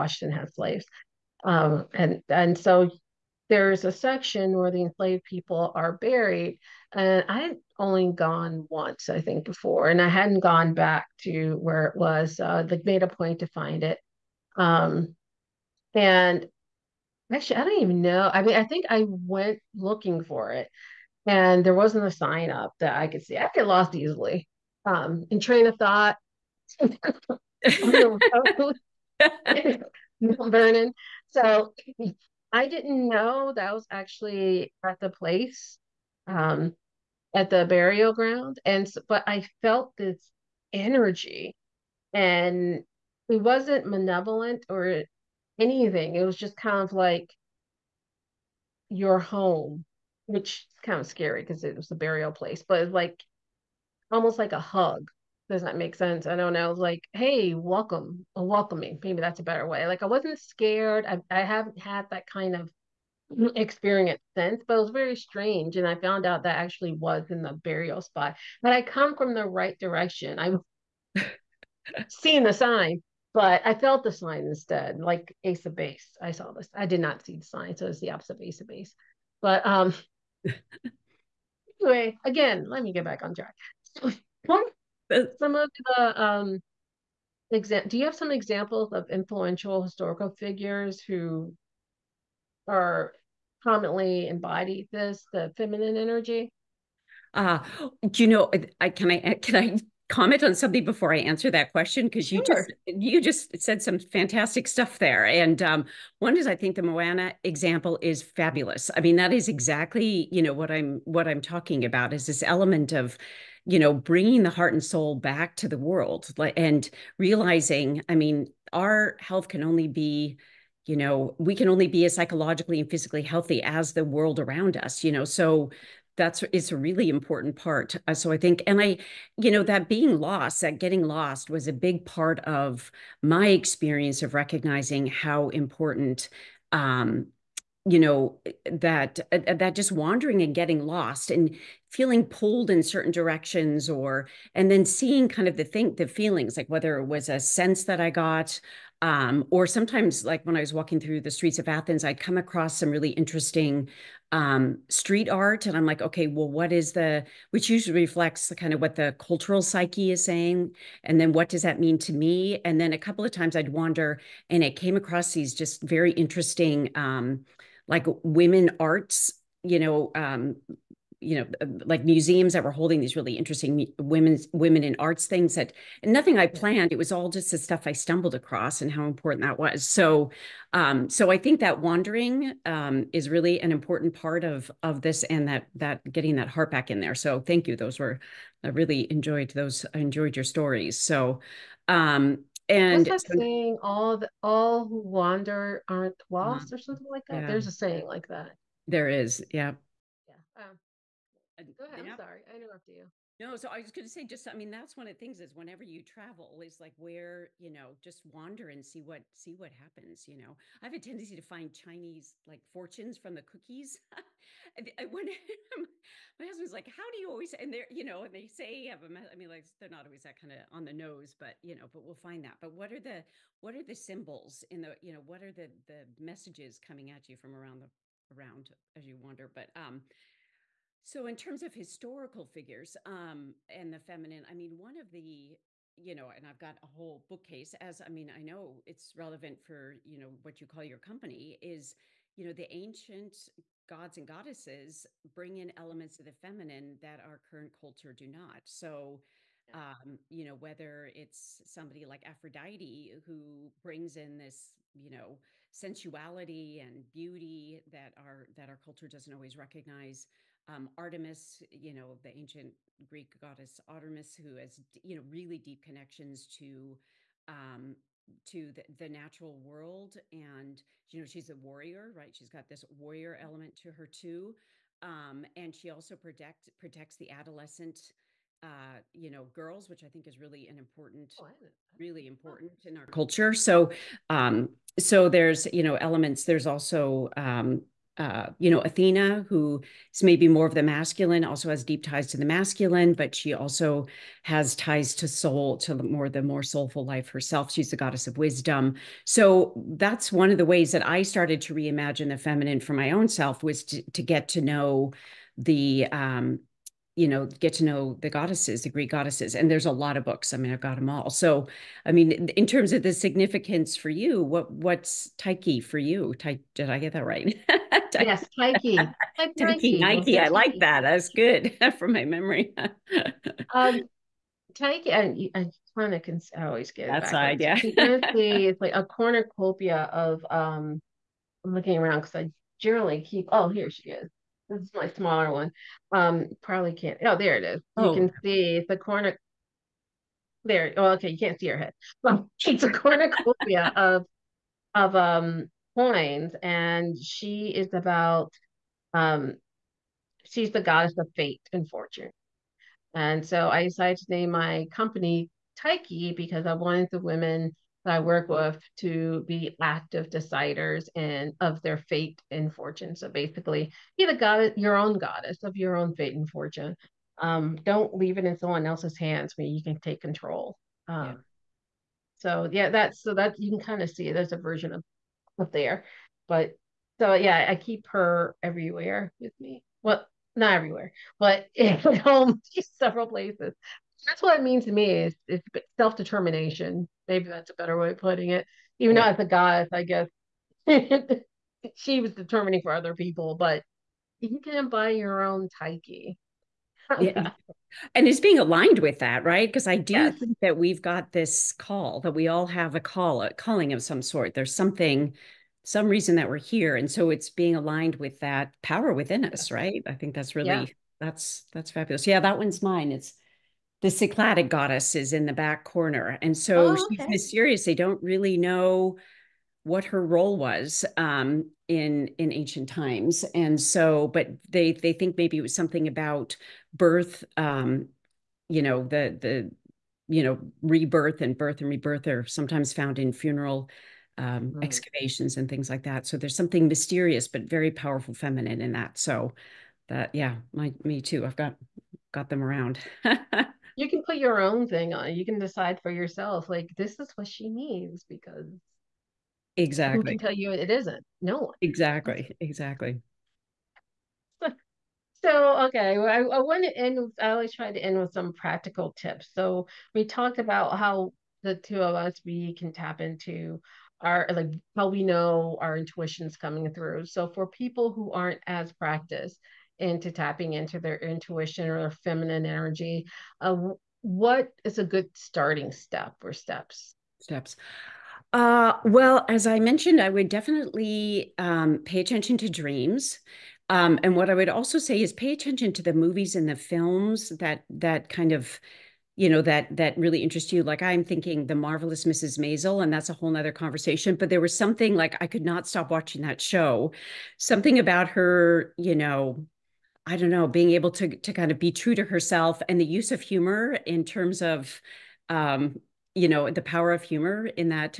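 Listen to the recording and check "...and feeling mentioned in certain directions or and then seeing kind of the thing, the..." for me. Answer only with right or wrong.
wrong.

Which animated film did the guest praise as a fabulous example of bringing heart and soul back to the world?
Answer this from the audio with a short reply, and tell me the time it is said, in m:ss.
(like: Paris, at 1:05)
Moana, at 1:46.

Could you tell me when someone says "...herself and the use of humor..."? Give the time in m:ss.
8:22.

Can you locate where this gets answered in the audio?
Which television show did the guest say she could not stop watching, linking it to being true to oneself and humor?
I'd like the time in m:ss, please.
8:11.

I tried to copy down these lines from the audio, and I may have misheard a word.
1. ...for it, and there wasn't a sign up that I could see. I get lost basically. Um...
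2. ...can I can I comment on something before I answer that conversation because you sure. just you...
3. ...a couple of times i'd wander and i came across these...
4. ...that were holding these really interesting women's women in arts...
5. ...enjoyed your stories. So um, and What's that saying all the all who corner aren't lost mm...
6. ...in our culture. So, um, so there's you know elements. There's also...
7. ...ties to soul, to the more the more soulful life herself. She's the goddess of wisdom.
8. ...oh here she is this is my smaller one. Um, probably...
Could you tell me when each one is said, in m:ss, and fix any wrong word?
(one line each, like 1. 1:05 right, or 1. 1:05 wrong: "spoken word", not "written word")
1. 0:20 wrong: "easily", not "basically"
2. 1:38 wrong: "question", not "conversation"
3. 2:42 right
4. 2:52 right
5. 3:09 wrong: "wander", not "corner"
6. 4:42 right
7. 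4:54 right
8. 5:33 right.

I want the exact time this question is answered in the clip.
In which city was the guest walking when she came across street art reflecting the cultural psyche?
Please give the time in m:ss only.
2:31.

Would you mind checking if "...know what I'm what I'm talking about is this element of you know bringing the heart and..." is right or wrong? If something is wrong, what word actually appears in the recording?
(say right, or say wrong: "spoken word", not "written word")
right.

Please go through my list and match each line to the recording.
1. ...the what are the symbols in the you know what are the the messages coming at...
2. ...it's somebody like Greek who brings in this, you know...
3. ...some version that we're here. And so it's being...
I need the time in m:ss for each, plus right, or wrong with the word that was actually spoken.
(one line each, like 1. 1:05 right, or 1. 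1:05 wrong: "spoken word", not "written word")
1. 3:43 right
2. 4:11 wrong: "Aphrodite", not "Greek"
3. 6:45 wrong: "reason", not "version".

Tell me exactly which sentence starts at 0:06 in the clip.
And I had only gone once, I think, before, and I hadn't gone back to where it was.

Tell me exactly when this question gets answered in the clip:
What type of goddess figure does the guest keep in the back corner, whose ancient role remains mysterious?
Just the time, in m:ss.
6:54.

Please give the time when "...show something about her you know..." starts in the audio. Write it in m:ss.
8:16.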